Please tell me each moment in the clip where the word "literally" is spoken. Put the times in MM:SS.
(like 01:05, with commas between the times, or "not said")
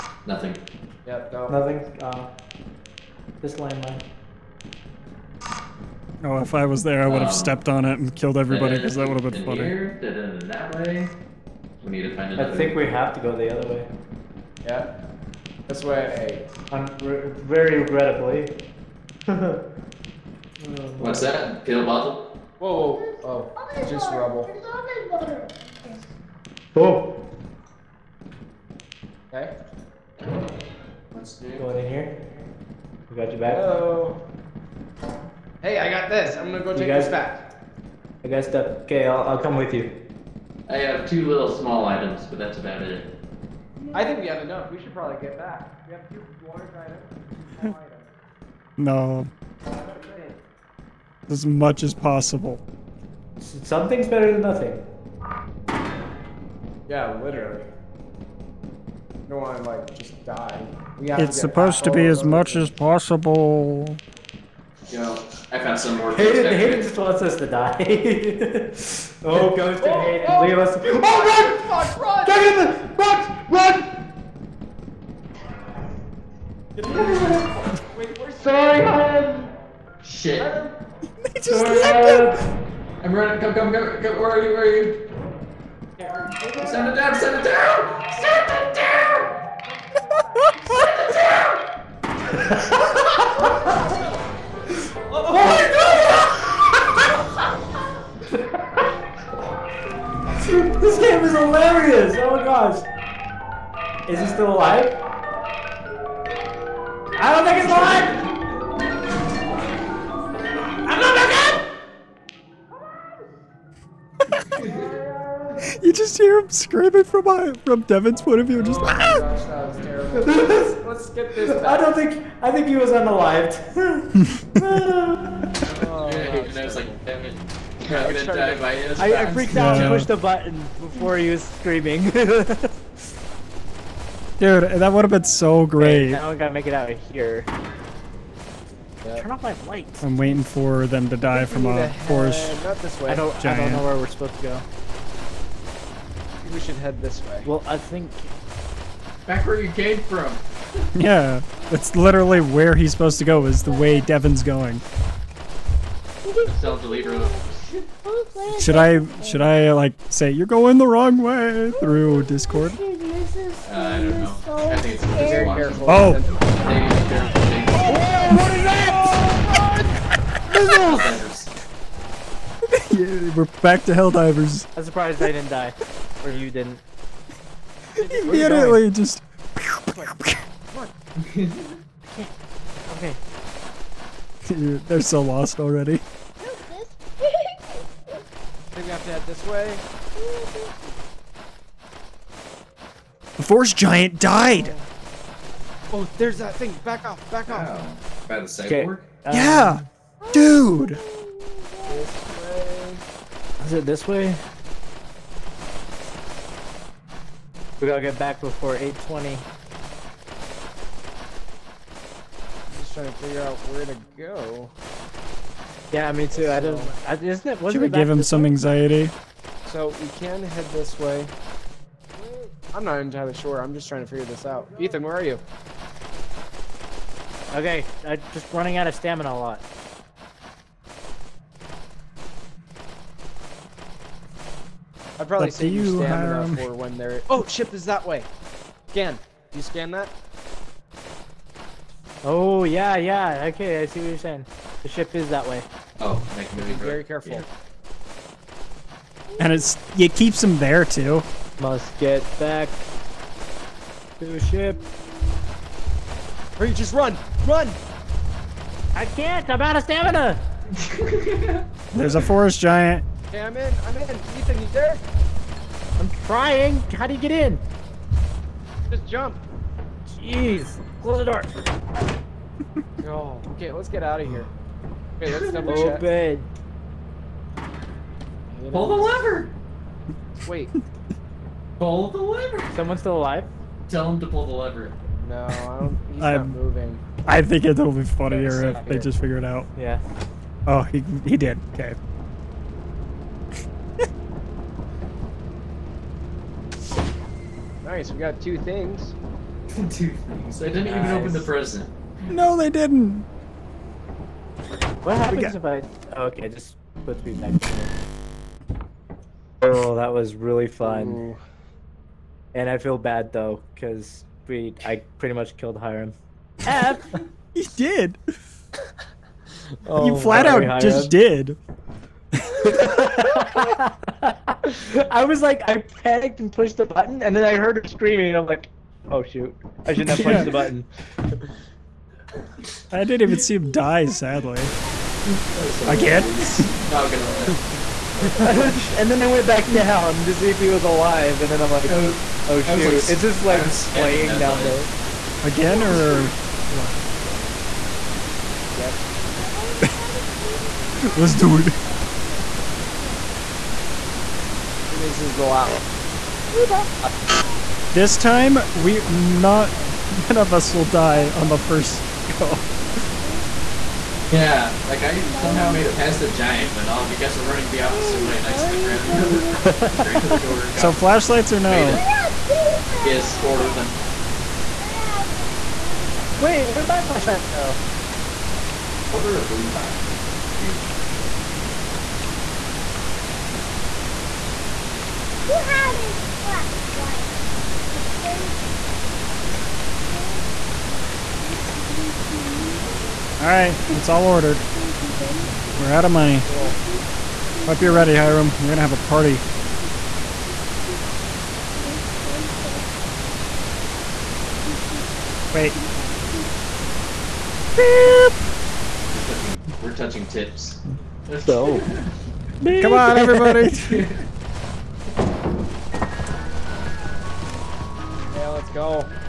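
00:57, 02:31.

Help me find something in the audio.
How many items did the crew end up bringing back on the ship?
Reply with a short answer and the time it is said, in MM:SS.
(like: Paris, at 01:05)
2, at 04:58.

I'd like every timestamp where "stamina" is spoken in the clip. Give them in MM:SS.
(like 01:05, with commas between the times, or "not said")
03:48, 03:55, 04:19.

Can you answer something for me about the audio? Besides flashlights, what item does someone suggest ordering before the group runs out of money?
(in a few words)
Boombox.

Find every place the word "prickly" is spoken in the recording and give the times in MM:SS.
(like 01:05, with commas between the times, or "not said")
not said.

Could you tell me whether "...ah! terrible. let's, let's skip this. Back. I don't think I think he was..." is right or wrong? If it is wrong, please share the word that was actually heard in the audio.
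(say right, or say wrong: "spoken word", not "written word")
right.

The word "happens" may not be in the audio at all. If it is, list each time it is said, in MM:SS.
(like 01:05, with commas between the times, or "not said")
05:05.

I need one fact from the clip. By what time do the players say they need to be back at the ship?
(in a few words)
8:20.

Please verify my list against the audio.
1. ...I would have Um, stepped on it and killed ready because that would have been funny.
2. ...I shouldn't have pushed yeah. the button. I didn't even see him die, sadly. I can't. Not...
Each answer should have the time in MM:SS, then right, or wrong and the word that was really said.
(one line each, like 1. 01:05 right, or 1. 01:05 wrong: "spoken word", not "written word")
1. 00:07 wrong: "everybody", not "ready"
2. 05:29 right.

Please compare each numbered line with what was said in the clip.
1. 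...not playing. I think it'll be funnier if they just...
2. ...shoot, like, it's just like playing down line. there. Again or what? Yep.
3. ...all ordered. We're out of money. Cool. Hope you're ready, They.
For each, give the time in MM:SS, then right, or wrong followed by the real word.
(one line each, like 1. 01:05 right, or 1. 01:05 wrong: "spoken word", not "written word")
1. 04:46 wrong: "moving", not "playing"
2. 05:42 right
3. 06:34 wrong: "Hiram", not "They".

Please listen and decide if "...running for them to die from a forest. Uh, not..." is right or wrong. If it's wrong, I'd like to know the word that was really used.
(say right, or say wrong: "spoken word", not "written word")
wrong: "waiting", not "running".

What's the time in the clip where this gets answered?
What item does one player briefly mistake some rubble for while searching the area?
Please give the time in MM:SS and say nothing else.
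00:21.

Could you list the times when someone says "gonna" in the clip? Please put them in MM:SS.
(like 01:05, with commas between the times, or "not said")
00:36, 02:08, 05:37, 06:38.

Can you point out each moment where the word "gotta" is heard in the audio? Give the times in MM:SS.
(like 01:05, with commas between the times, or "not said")
02:16, 03:27.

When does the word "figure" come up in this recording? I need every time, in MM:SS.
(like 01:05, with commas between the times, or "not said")
03:33, 03:44, 04:49.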